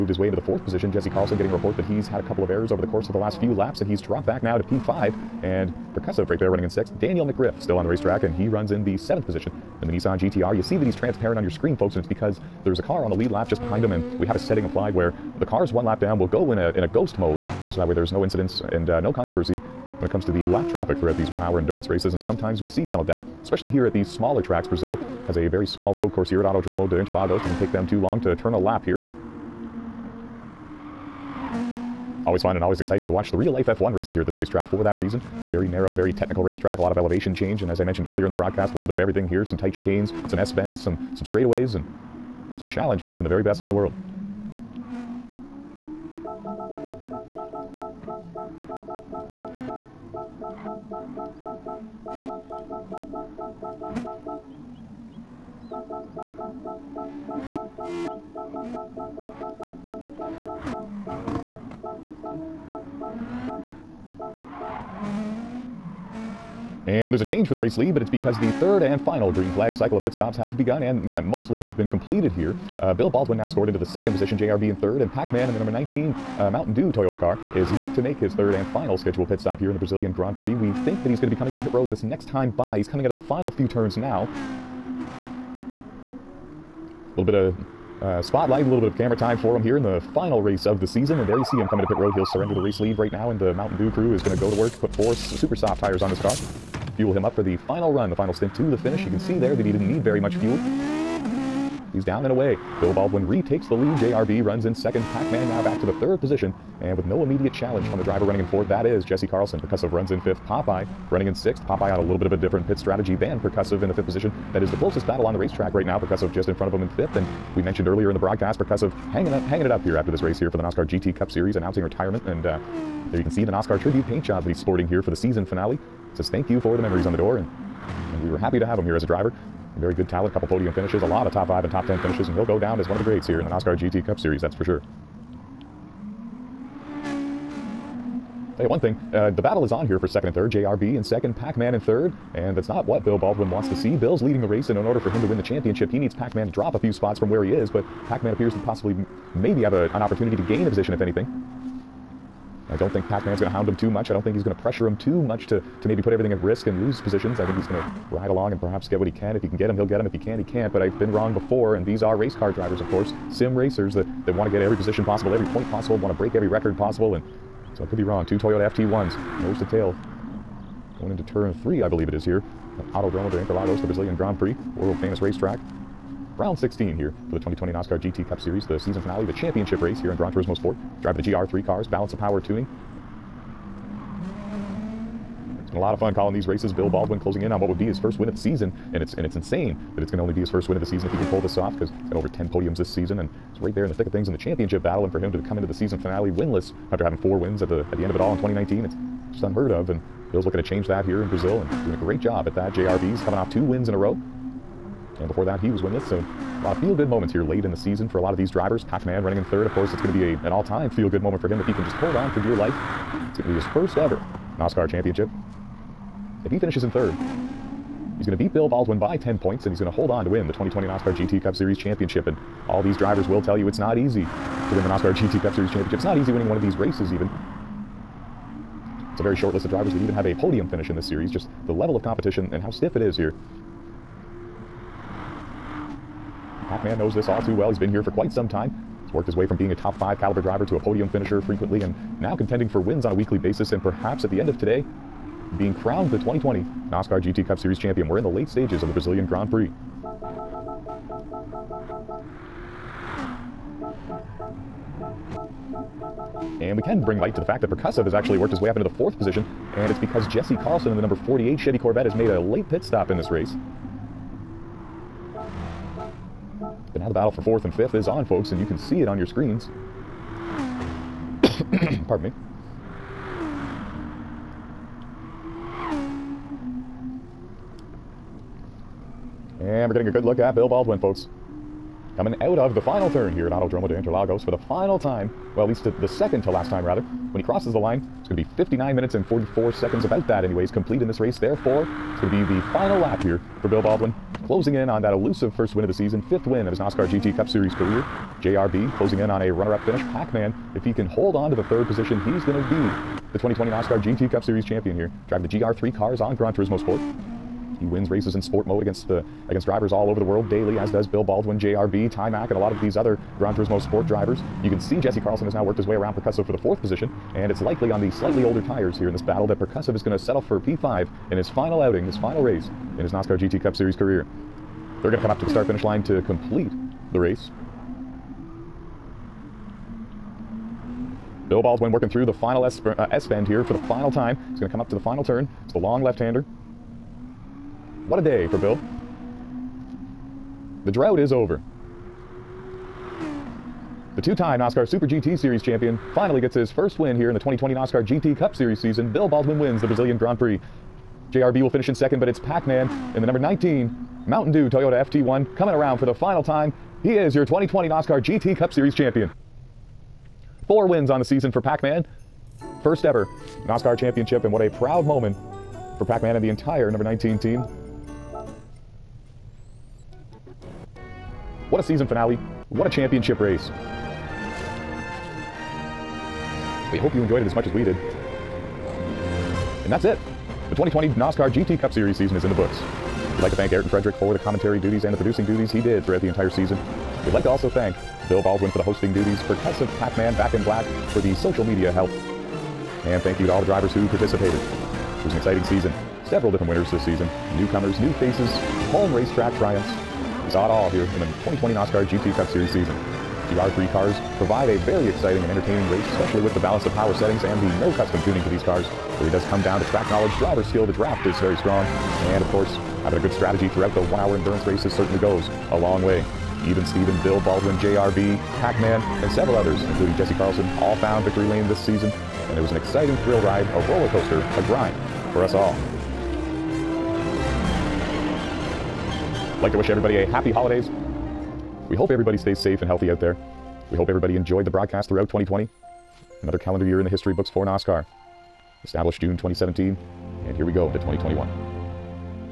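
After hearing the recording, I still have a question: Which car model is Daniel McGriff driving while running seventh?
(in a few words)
Nissan GTR.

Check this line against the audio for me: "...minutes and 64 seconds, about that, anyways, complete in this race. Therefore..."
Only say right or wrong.
wrong.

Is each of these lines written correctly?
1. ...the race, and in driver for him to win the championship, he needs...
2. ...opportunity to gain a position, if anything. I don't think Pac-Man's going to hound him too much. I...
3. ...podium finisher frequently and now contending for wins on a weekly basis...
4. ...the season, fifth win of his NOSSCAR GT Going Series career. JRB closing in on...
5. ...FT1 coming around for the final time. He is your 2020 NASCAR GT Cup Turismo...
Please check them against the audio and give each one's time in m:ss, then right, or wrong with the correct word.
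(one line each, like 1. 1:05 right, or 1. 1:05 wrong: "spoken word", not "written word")
1. 2:24 wrong: "order", not "driver"
2. 2:29 right
3. 4:00 right
4. 4:55 wrong: "Cup", not "Going"
5. 5:55 wrong: "Series", not "Turismo".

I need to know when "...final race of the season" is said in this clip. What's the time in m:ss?
1:30.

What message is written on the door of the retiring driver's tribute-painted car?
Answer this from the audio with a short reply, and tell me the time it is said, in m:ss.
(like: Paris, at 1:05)
thank you for the memories, at 2:06.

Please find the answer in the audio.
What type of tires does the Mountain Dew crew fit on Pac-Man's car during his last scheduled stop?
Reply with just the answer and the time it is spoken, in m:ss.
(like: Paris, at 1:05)
super soft, at 1:35.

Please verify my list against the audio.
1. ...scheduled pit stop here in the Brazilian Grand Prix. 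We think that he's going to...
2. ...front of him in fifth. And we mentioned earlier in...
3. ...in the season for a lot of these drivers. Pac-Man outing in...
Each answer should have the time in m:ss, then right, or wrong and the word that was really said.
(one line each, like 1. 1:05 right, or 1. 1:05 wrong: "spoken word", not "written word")
1. 1:18 right
2. 1:56 right
3. 3:27 wrong: "running", not "outing".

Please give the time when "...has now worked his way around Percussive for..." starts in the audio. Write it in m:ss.
5:15.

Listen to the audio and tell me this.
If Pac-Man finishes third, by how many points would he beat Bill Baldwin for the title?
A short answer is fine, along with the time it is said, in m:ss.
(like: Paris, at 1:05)
10, at 3:39.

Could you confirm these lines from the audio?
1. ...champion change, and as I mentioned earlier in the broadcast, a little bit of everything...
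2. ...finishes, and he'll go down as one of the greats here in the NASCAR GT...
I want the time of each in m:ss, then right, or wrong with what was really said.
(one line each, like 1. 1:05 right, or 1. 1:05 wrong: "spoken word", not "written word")
1. 0:36 wrong: "elevation", not "champion"
2. 2:12 wrong: "NOSSCAR", not "NASCAR".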